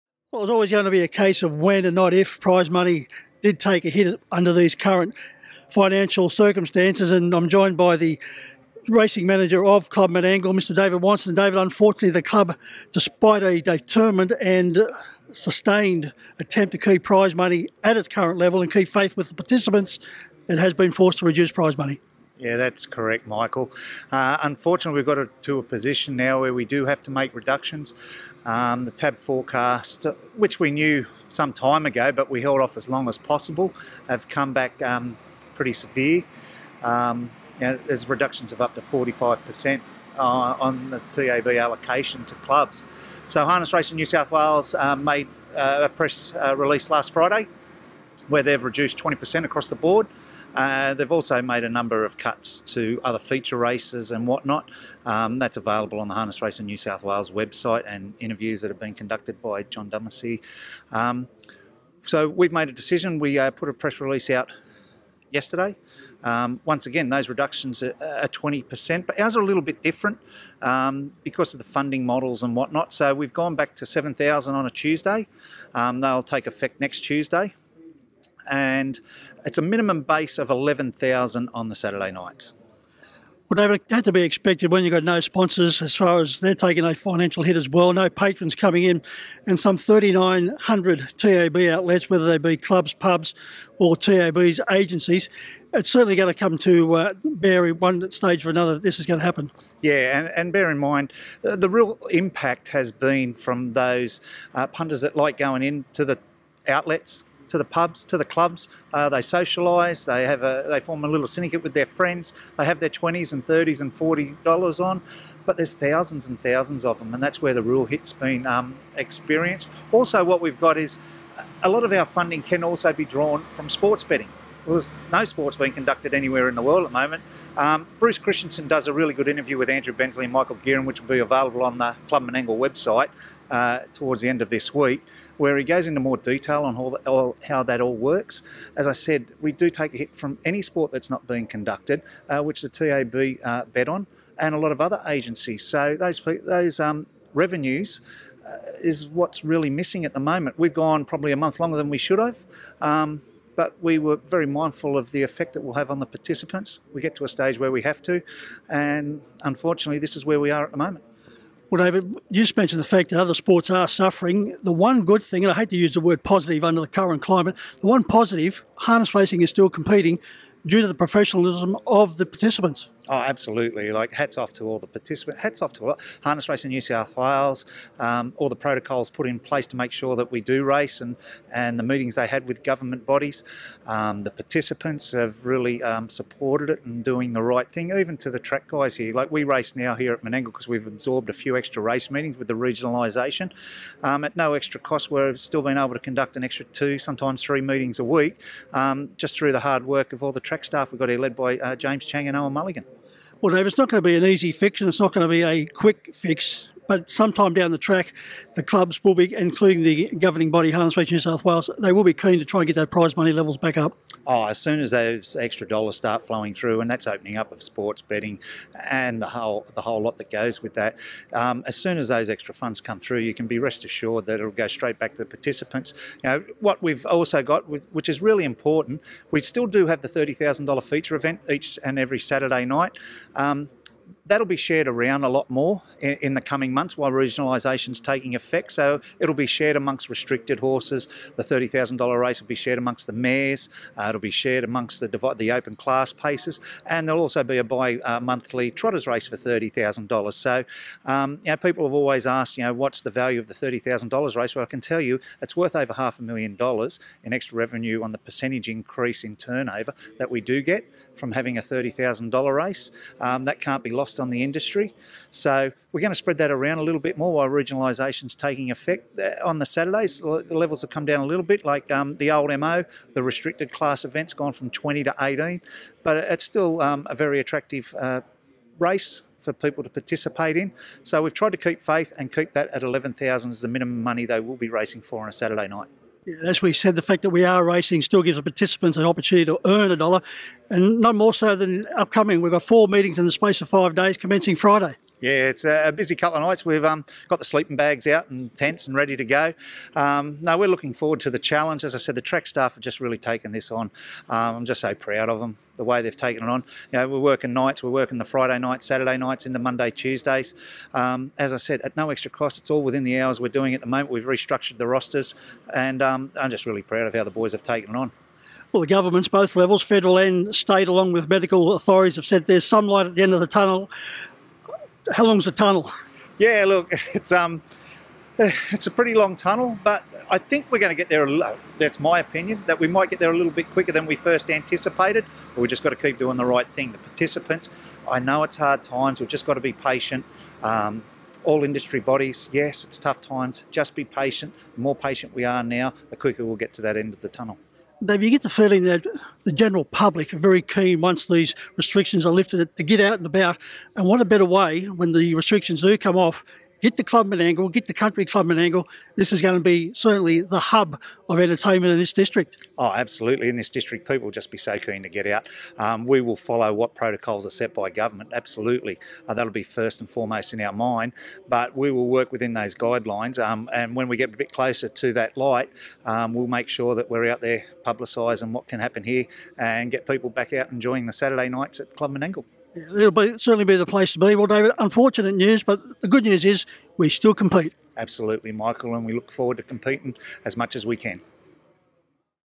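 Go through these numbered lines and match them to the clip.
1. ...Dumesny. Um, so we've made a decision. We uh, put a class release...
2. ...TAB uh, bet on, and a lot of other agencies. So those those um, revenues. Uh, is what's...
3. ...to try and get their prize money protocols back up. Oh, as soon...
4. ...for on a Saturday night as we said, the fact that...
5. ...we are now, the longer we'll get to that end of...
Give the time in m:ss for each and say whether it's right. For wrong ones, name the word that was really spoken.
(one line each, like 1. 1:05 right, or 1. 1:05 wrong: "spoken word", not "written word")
1. 0:59 wrong: "press", not "class"
2. 2:22 right
3. 3:32 wrong: "levels", not "protocols"
4. 4:45 right
5. 5:45 wrong: "quicker", not "longer".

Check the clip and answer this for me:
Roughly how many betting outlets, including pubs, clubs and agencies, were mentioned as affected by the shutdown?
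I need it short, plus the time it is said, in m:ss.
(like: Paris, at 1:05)
3,900, at 1:29.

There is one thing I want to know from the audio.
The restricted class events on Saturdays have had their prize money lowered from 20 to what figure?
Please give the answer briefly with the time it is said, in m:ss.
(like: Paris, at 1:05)
18, at 4:35.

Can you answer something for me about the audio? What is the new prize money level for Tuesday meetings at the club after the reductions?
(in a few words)
7,000.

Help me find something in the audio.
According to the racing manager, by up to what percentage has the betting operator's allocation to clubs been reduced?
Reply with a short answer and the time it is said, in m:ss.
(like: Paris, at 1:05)
45%, at 0:38.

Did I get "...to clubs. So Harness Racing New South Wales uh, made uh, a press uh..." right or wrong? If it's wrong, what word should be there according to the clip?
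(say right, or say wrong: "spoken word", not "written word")
right.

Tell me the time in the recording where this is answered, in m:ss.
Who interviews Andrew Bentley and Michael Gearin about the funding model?
2:07.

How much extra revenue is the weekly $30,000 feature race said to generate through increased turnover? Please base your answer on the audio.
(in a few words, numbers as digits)
over half a million dollars.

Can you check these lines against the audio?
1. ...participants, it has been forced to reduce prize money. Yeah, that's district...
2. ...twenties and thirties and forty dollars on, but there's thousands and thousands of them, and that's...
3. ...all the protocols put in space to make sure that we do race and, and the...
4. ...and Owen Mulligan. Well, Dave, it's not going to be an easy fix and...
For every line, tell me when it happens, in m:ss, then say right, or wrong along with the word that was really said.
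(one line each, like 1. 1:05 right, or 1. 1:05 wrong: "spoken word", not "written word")
1. 0:19 wrong: "correct", not "district"
2. 1:52 right
3. 2:58 wrong: "place", not "space"
4. 3:22 right.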